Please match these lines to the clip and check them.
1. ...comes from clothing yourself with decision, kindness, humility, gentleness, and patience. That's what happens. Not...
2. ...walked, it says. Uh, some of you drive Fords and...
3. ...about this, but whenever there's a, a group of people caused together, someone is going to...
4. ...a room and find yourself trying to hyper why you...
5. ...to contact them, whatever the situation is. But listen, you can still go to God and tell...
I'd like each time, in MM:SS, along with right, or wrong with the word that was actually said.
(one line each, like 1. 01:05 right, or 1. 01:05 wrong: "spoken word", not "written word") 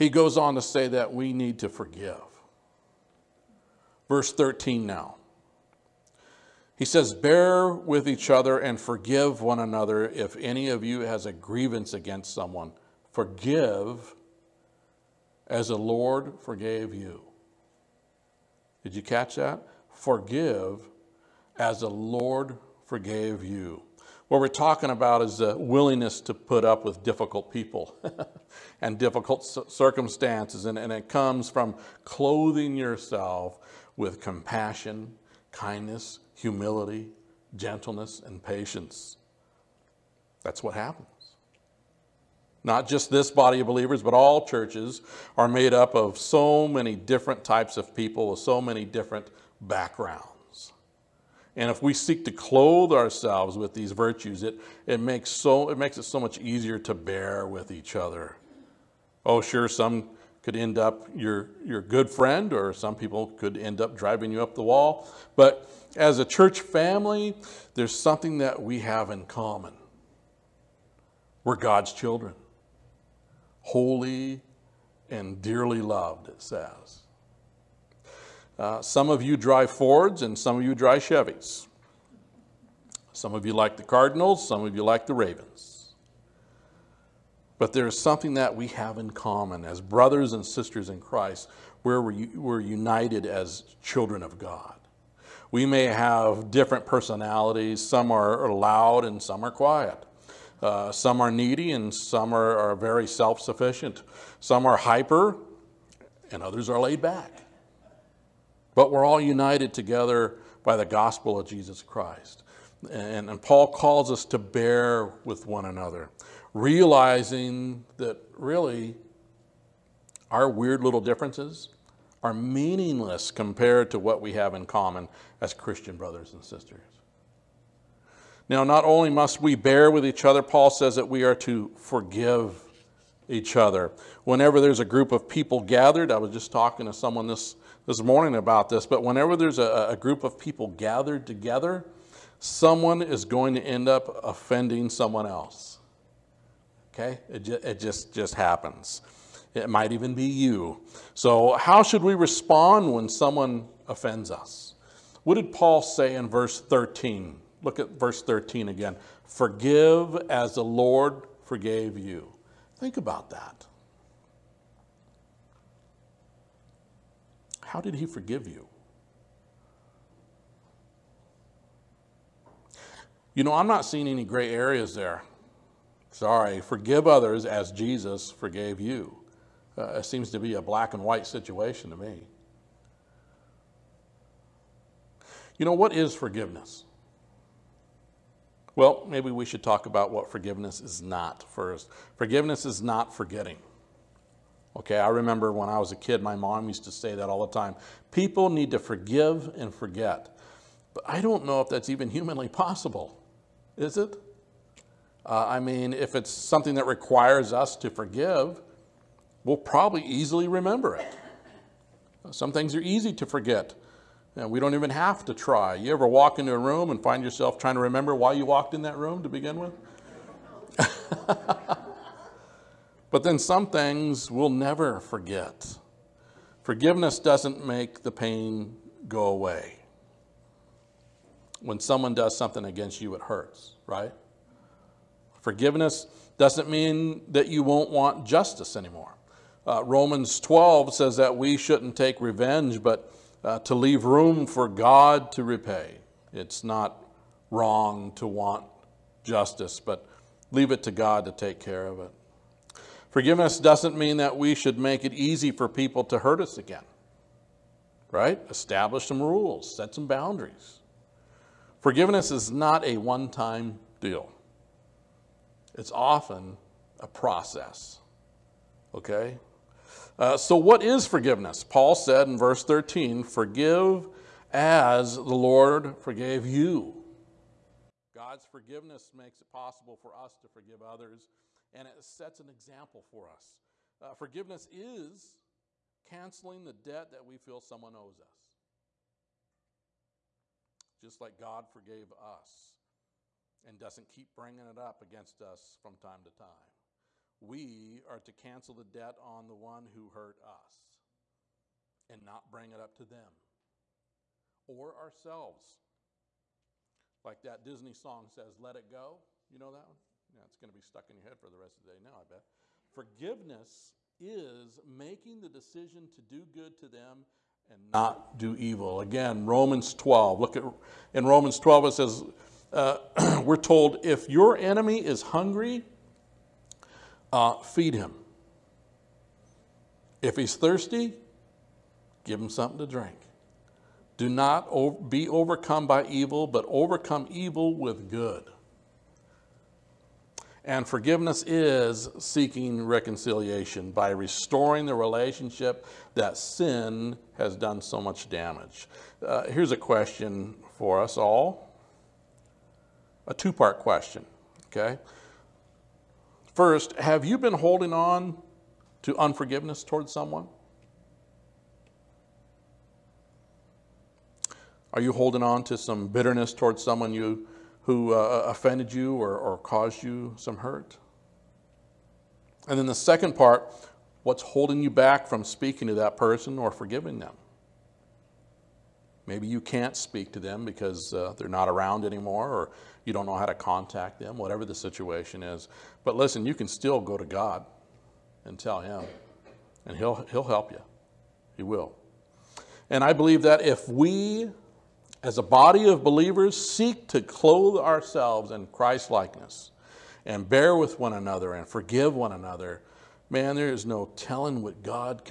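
1. 00:31 wrong: "compassion", not "decision"
2. 01:15 wrong: "loved", not "walked"
3. 02:18 wrong: "gathered", not "caused"
4. 03:36 wrong: "remember", not "hyper"
5. 06:23 right.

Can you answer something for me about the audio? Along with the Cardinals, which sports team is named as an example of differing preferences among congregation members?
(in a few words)
Ravens.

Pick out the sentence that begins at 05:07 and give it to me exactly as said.
Like that Disney song says, Let It Go.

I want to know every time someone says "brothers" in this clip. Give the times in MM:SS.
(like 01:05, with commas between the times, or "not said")
01:29, 02:05.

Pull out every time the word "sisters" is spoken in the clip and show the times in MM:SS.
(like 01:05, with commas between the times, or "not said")
01:30, 02:06.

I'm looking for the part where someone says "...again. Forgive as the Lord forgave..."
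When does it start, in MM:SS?
02:38.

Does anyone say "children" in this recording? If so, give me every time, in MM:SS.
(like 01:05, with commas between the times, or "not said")
01:11, 01:33.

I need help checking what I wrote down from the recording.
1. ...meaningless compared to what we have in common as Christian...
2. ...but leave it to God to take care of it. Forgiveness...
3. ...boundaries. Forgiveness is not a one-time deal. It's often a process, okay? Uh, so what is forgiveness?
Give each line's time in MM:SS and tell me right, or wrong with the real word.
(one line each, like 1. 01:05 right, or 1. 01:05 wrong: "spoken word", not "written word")
1. 02:02 right
2. 04:09 right
3. 04:20 right.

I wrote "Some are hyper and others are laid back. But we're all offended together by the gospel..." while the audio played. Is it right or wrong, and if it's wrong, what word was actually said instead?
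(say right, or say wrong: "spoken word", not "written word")
wrong: "united", not "offended".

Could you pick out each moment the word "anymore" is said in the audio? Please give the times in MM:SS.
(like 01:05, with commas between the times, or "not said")
03:58, 06:22.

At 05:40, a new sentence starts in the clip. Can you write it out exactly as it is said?
And forgiveness is seeking reconciliation by restoring the relationship that sin has done so much damage.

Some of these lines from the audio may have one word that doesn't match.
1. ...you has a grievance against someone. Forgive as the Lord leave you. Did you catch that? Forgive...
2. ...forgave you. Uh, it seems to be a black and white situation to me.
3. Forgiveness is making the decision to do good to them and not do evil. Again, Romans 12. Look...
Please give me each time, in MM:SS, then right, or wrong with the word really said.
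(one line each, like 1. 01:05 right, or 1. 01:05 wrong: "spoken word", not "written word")
1. 00:10 wrong: "forgave", not "leave"
2. 02:58 right
3. 05:12 right.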